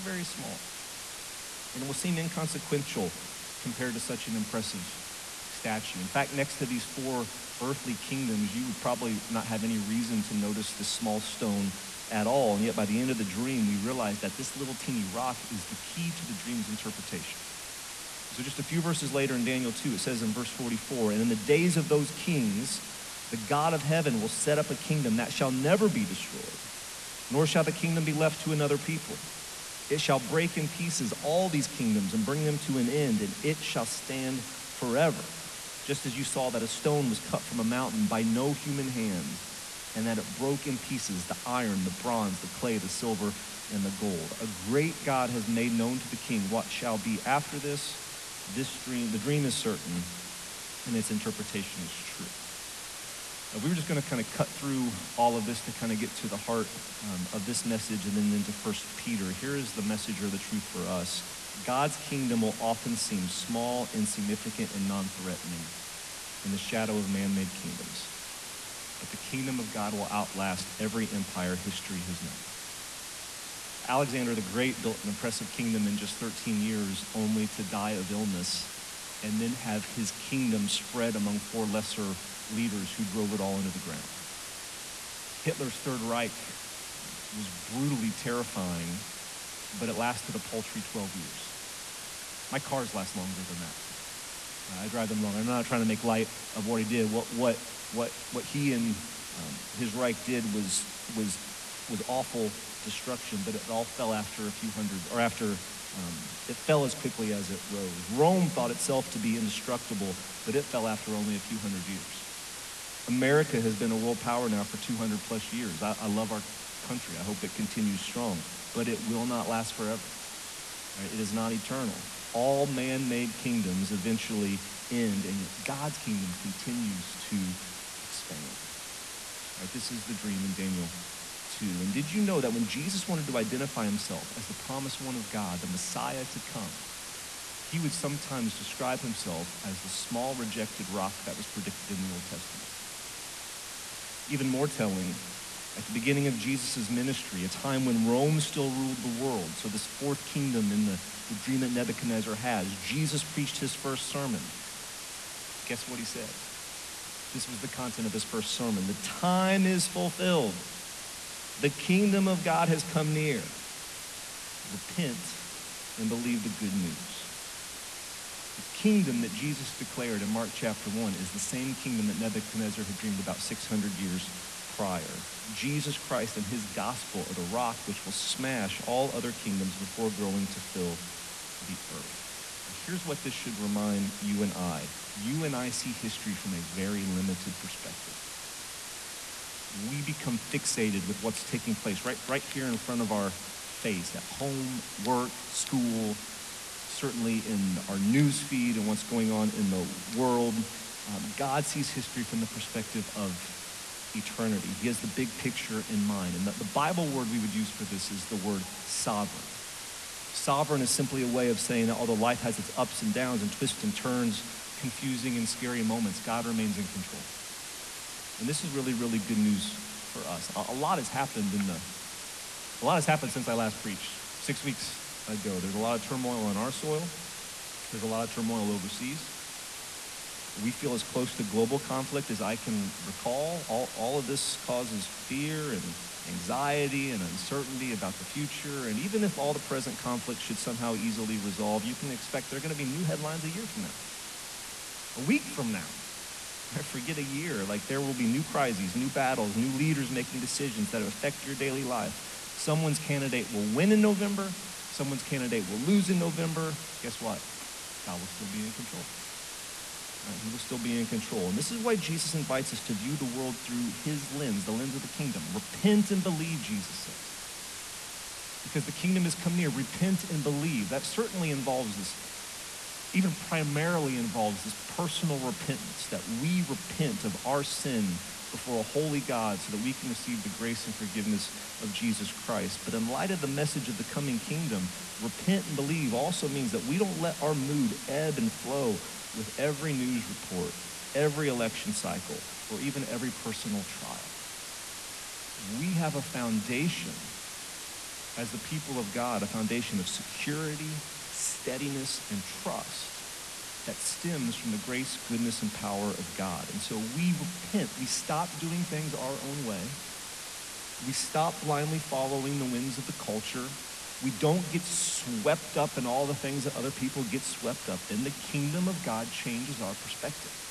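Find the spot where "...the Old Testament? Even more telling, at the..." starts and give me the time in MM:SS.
02:22.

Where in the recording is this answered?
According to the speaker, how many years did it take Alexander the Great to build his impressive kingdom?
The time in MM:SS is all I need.
01:16.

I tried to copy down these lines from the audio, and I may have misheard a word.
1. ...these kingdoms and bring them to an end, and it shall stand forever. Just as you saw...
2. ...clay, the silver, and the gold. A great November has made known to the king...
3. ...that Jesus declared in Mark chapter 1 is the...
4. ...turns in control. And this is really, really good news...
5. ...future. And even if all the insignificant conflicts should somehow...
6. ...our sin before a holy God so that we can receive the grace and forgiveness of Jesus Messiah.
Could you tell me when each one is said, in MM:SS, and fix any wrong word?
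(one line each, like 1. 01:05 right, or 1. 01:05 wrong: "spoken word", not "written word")
1. 00:31 right
2. 00:42 wrong: "God", not "November"
3. 02:49 right
4. 03:36 wrong: "remains", not "turns"
5. 03:58 wrong: "present", not "insignificant"
6. 04:37 wrong: "Christ", not "Messiah".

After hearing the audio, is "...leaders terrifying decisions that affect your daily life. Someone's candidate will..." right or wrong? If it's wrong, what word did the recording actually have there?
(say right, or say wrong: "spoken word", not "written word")
wrong: "making", not "terrifying".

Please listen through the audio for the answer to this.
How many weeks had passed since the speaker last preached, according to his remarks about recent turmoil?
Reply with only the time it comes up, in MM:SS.
03:44.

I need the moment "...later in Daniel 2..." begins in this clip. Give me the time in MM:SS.
00:19.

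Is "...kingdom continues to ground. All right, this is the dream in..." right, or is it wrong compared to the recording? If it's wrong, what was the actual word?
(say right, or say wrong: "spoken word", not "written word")
wrong: "expand", not "ground".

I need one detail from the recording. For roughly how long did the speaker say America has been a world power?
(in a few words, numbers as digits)
200 plus years.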